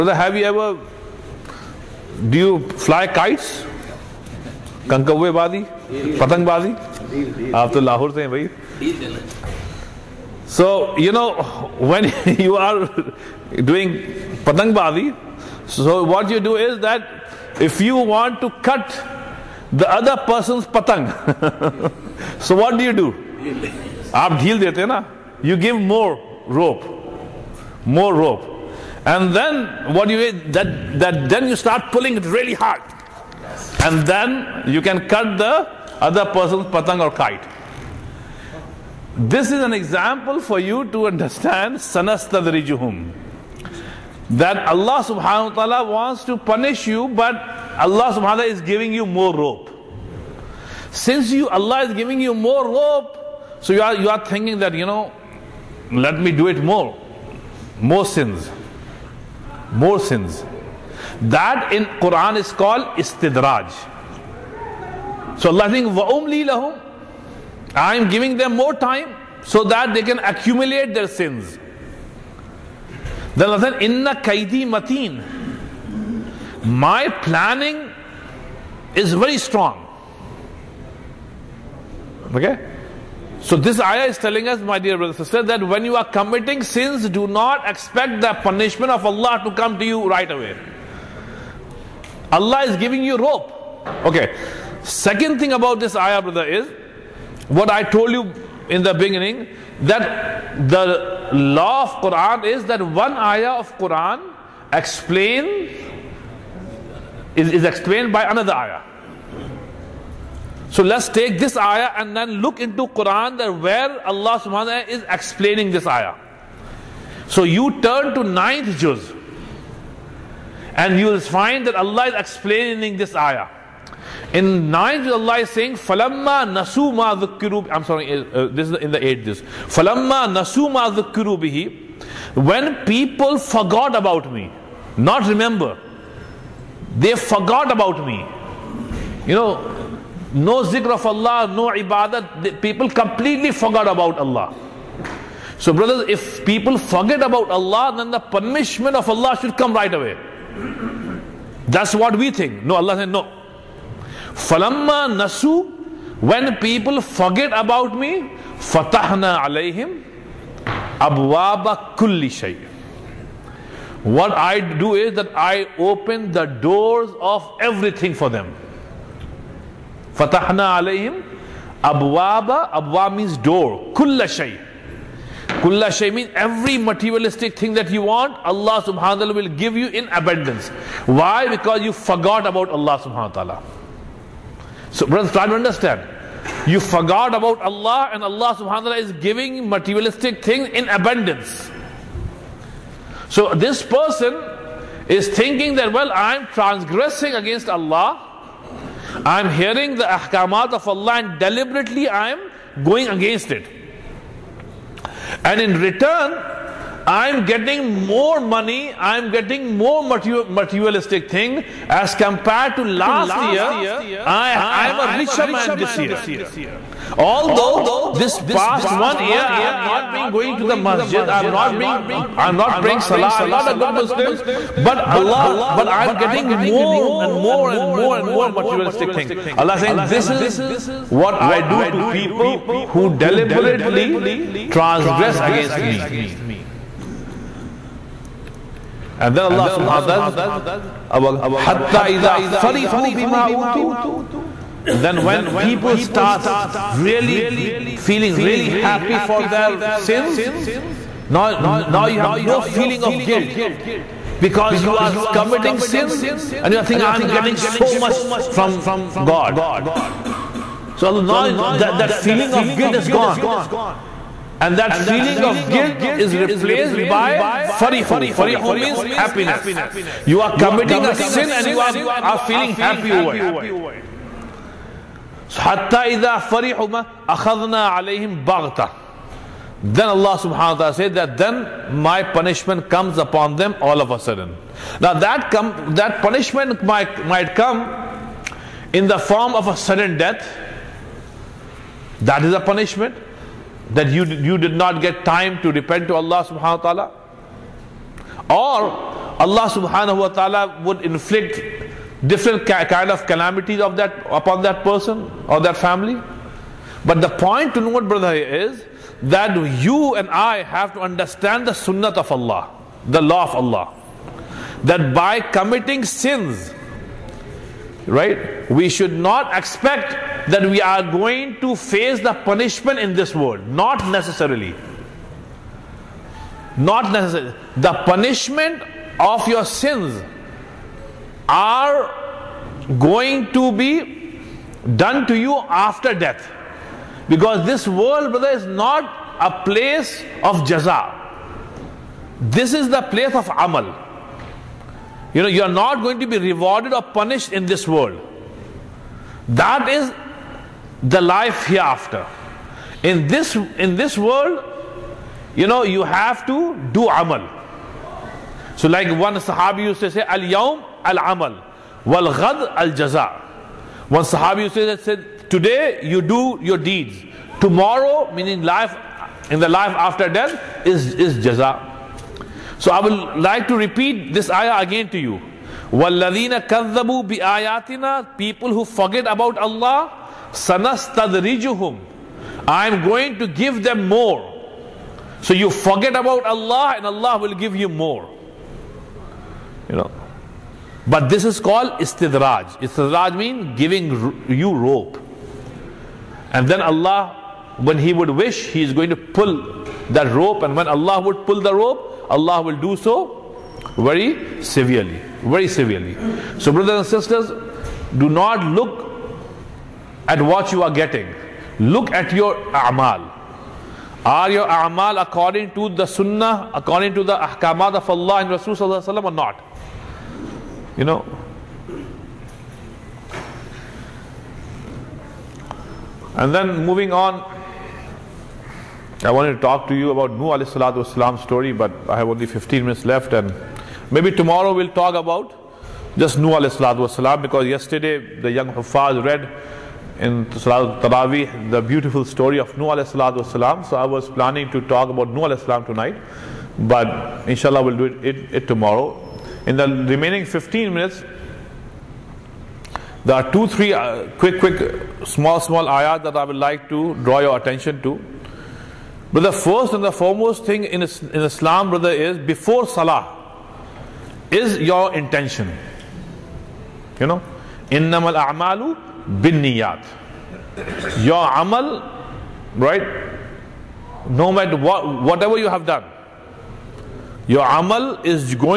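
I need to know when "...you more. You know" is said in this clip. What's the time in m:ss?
6:27.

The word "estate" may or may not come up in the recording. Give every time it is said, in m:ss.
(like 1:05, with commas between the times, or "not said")
not said.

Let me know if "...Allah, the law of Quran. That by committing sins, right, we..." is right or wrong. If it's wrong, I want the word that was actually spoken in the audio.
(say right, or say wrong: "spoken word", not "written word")
wrong: "Allah", not "Quran".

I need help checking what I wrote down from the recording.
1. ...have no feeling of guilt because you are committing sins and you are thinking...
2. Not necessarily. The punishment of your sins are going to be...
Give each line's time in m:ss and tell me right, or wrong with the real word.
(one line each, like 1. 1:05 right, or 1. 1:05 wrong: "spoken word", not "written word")
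1. 4:12 right
2. 5:26 right.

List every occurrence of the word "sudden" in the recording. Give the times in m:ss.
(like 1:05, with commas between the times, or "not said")
4:44, 4:49.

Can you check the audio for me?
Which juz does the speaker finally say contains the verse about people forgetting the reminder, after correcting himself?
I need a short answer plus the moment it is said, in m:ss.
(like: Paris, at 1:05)
Eighth juz, at 2:09.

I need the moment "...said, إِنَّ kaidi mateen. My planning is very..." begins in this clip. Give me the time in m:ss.
1:13.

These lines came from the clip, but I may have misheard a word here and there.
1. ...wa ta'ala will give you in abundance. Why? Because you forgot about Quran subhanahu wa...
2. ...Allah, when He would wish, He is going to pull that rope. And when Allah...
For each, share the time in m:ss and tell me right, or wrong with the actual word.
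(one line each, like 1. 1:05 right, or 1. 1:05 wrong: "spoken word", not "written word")
1. 2:58 wrong: "Allah", not "Quran"
2. 6:36 right.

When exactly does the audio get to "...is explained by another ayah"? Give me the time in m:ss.
1:47.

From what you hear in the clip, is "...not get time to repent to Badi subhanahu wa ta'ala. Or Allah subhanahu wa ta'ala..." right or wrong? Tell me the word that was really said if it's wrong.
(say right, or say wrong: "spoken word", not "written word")
wrong: "Allah", not "Badi".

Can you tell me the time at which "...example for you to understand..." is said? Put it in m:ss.
0:39.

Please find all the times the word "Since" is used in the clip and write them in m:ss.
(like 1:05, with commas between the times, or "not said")
0:50.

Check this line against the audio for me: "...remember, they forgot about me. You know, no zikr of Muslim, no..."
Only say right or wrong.
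wrong.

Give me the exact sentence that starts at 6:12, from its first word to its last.
So I will like to repeat this ayah again to you.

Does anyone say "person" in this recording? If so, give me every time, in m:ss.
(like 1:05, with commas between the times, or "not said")
0:20, 0:36, 3:13, 5:04.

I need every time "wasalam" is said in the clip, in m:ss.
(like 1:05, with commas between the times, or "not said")
7:11, 7:17, 7:23.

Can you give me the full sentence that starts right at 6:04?
One Sahabi said, today you do your deeds.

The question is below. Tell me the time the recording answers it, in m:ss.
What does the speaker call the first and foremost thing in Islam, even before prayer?
7:44.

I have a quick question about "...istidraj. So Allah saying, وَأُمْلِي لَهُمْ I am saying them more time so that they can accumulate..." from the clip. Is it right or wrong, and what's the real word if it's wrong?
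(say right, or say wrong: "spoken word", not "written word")
wrong: "giving", not "saying".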